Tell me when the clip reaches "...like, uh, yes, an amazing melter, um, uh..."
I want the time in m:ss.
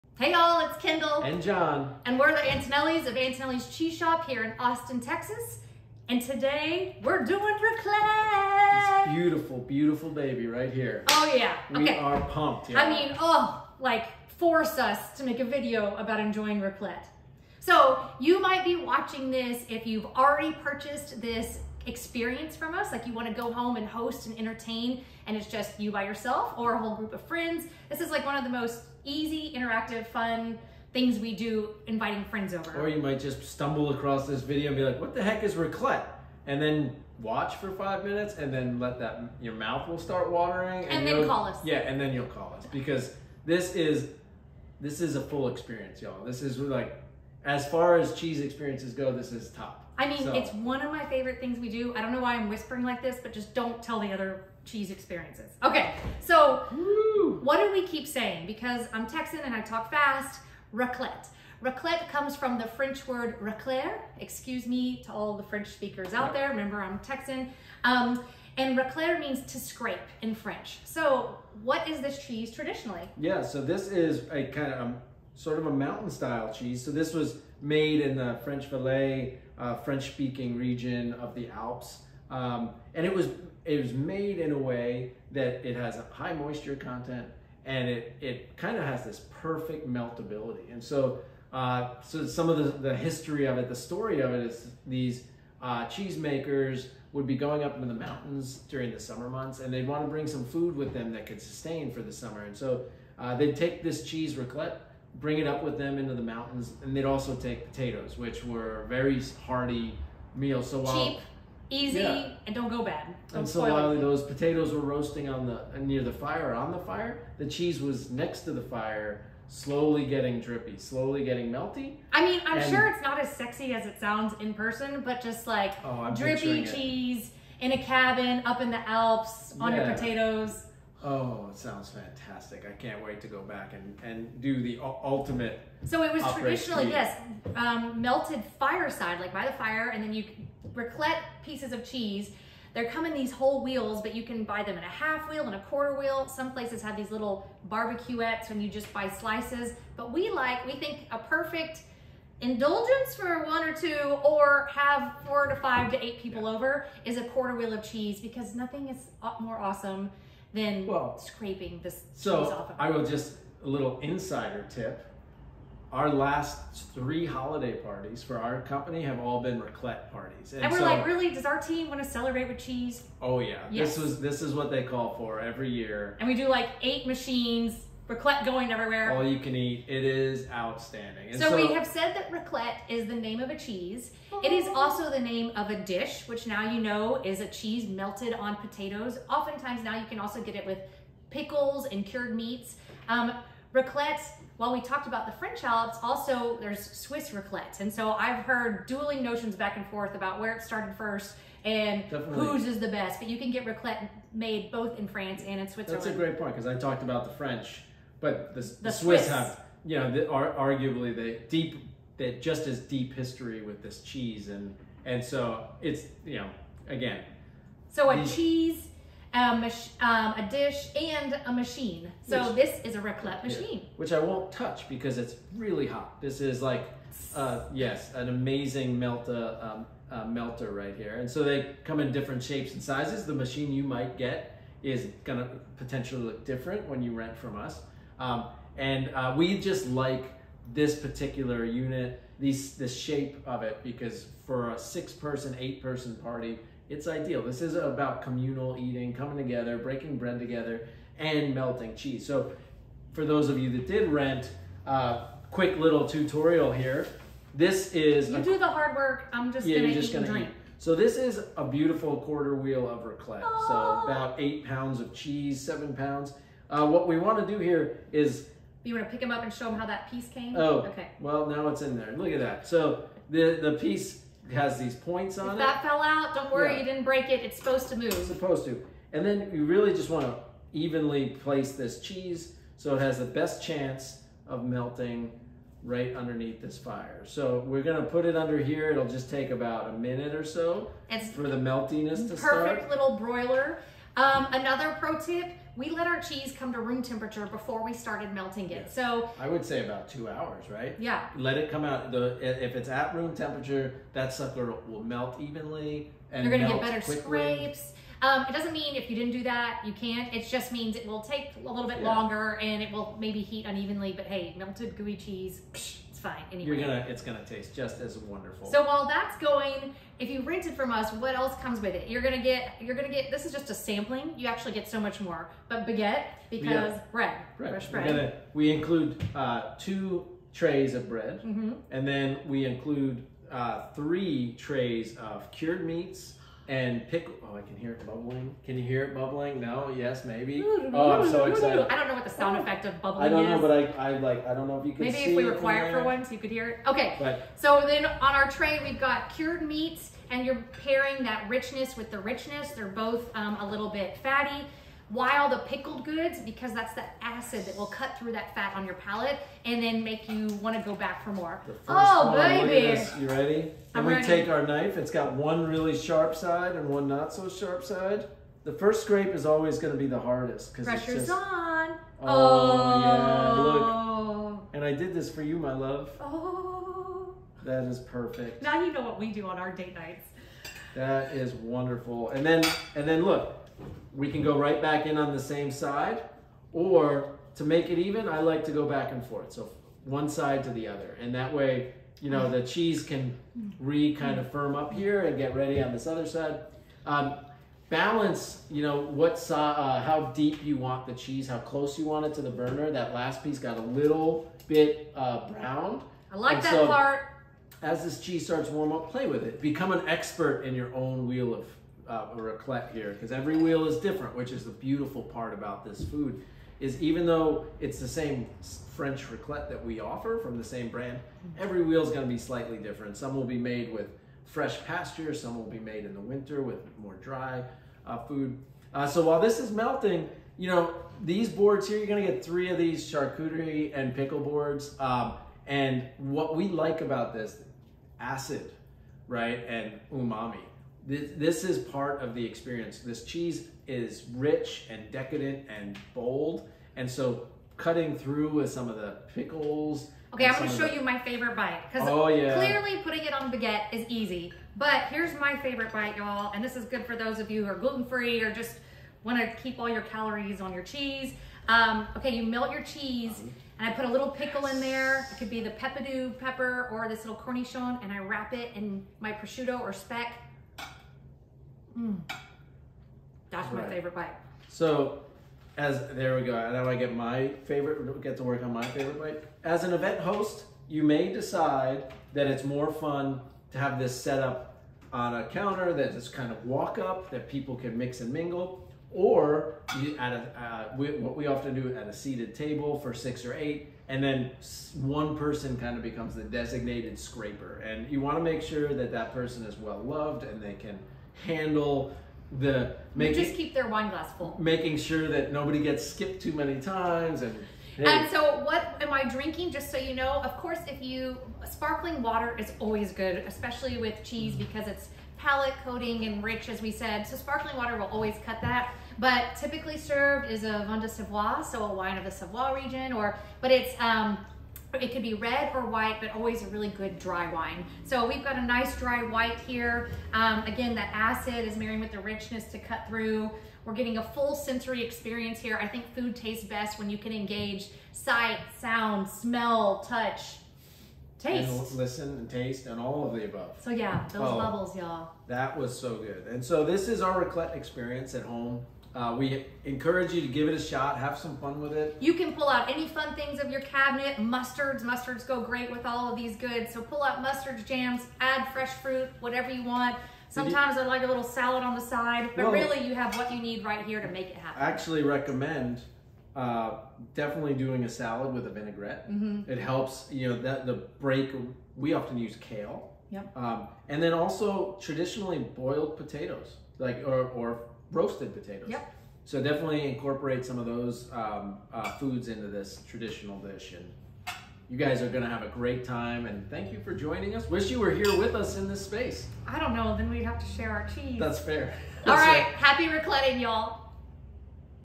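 3:46.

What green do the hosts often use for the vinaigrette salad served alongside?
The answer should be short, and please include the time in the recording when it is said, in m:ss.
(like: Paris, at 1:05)
Kale, at 9:32.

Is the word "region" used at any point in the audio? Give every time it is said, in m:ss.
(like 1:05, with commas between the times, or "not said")
1:20, 8:42.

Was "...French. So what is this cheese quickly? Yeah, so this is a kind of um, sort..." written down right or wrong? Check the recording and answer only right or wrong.
wrong.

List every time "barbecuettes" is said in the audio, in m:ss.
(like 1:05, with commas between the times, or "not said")
2:27.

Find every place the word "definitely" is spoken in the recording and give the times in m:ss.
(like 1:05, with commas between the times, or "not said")
3:22, 9:27, 9:39.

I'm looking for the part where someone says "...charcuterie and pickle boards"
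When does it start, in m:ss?
7:13.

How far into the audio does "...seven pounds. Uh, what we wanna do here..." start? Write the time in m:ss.
4:25.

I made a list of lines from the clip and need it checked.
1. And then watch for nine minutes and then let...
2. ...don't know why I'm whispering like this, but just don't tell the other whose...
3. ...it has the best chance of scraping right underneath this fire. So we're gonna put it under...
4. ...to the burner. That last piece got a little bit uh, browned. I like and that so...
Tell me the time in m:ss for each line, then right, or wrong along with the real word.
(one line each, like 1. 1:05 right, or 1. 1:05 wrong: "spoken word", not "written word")
1. 0:36 wrong: "five", not "nine"
2. 0:52 wrong: "cheese", not "whose"
3. 4:42 wrong: "melting", not "scraping"
4. 6:42 right.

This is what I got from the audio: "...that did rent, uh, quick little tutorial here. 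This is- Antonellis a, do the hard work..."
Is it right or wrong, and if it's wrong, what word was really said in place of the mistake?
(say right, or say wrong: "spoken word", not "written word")
wrong: "You", not "Antonellis".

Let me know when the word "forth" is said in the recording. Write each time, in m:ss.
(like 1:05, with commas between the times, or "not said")
3:19, 6:29.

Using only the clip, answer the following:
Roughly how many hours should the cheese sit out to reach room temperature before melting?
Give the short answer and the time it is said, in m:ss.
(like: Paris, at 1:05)
2 hours, at 5:00.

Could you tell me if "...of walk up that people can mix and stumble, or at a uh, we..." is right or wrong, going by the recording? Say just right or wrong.
wrong.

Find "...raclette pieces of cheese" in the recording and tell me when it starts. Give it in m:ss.
2:20.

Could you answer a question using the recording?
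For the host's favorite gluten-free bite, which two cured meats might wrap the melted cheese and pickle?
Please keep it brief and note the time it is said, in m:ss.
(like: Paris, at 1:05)
Prosciutto or speck, at 7:49.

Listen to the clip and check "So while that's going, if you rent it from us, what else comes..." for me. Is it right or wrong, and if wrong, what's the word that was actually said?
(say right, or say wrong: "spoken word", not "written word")
right.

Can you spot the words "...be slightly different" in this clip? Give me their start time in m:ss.
7:02.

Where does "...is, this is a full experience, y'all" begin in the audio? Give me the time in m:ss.
0:43.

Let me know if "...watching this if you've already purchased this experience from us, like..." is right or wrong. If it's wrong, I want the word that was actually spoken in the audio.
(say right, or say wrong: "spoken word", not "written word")
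right.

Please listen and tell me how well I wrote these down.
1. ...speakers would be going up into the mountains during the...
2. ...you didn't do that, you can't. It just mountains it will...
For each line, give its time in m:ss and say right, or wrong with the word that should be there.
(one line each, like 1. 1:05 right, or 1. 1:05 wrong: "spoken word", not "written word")
1. 1:35 wrong: "cheesemakers", not "speakers"
2. 5:09 wrong: "means", not "mountains".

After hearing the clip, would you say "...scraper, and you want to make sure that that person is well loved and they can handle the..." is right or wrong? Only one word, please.
right.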